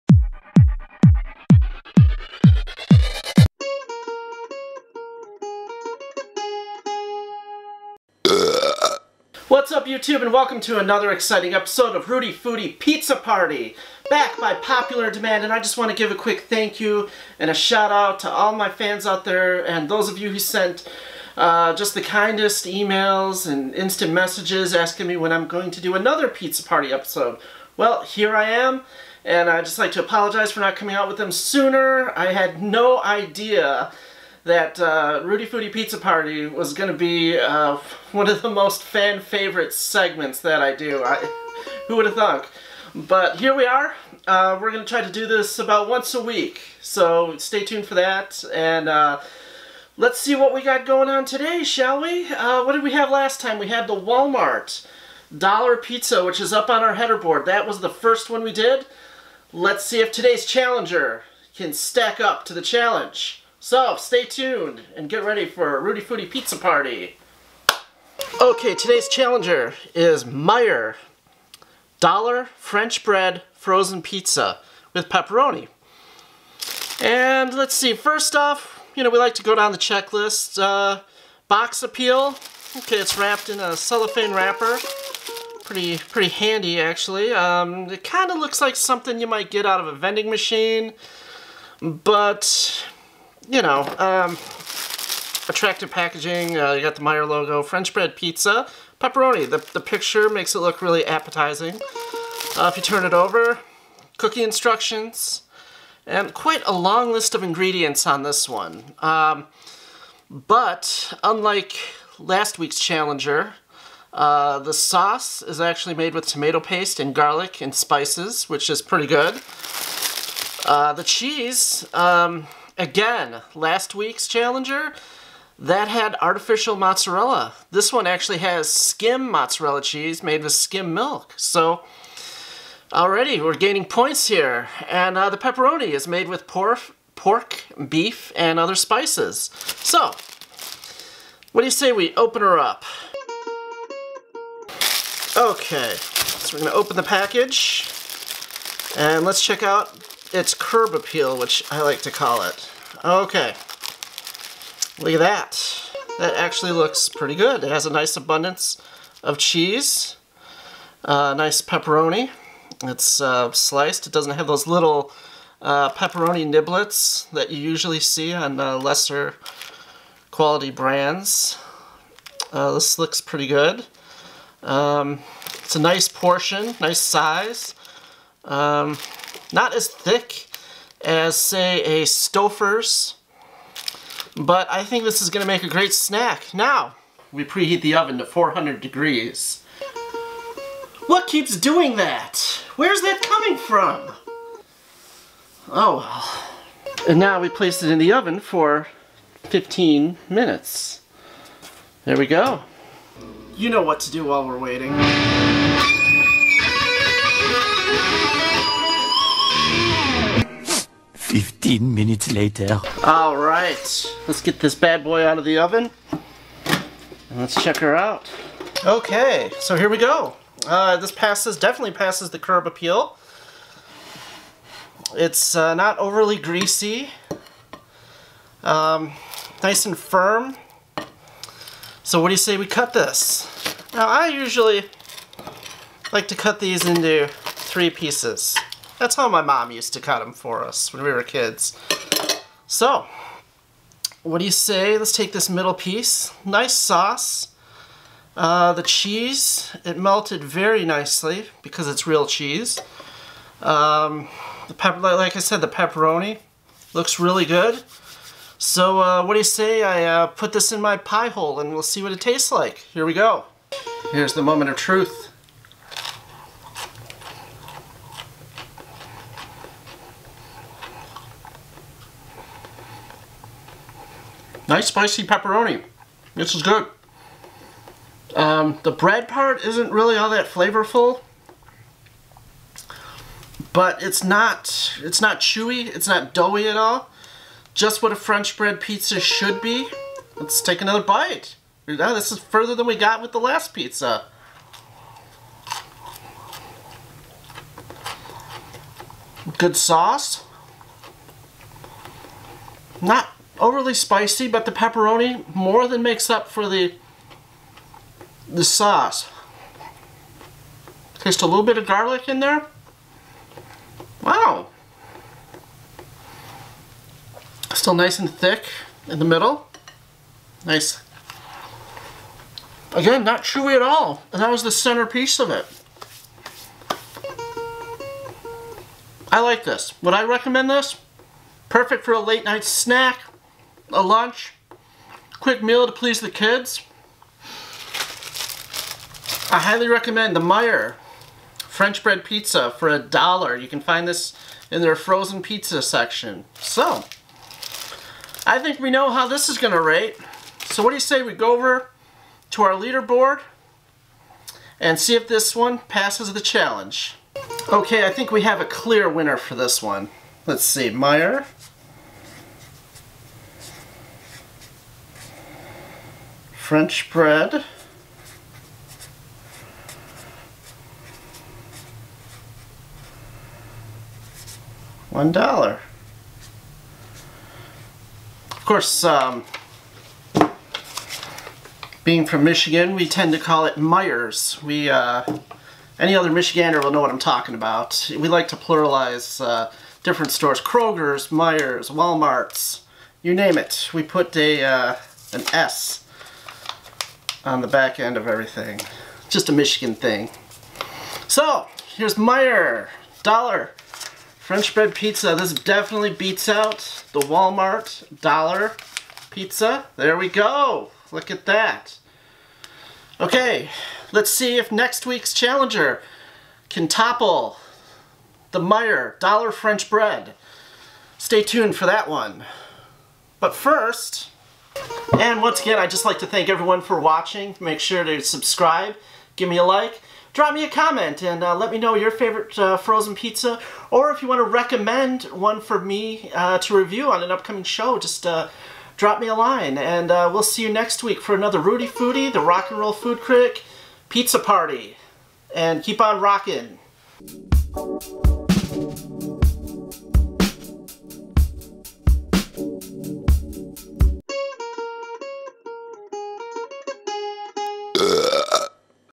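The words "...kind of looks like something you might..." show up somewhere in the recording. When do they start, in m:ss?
1:28.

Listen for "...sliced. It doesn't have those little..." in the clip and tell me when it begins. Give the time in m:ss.
2:43.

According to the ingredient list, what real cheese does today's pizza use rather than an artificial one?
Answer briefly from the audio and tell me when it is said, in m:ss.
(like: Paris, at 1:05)
Skim mozzarella, at 2:08.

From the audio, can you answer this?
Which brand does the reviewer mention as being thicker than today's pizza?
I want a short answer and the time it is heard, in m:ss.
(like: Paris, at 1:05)
Stouffer's, at 3:02.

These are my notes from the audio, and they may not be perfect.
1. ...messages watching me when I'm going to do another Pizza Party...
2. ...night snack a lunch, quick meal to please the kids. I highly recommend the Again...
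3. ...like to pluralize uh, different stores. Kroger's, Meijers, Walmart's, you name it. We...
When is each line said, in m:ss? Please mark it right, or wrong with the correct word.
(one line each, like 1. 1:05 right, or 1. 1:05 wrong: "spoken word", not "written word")
1. 0:24 wrong: "asking", not "watching"
2. 5:32 wrong: "Meijer", not "Again"
3. 6:28 right.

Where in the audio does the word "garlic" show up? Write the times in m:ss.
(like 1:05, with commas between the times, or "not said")
1:57, 5:11.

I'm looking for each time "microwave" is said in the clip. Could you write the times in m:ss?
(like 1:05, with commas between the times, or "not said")
not said.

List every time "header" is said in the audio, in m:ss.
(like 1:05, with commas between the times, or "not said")
0:56.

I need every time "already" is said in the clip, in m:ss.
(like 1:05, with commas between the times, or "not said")
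2:12.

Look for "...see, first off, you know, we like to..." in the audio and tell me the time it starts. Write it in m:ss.
1:17.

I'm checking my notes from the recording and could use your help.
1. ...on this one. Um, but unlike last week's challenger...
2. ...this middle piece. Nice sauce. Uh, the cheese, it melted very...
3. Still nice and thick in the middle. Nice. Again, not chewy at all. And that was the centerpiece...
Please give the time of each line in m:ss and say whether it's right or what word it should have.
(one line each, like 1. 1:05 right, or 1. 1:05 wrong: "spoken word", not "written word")
1. 1:48 right
2. 4:05 right
3. 5:17 right.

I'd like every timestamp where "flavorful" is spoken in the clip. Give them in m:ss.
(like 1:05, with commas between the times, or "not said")
4:40.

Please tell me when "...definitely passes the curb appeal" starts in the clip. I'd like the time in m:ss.
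3:41.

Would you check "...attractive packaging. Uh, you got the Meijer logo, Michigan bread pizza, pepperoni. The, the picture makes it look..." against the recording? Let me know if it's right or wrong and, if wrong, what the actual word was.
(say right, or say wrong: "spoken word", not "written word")
wrong: "French", not "Michigan".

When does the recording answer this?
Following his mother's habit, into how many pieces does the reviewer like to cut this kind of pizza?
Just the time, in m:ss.
3:57.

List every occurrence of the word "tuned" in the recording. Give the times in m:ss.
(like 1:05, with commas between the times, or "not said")
0:47, 1:04, 7:01.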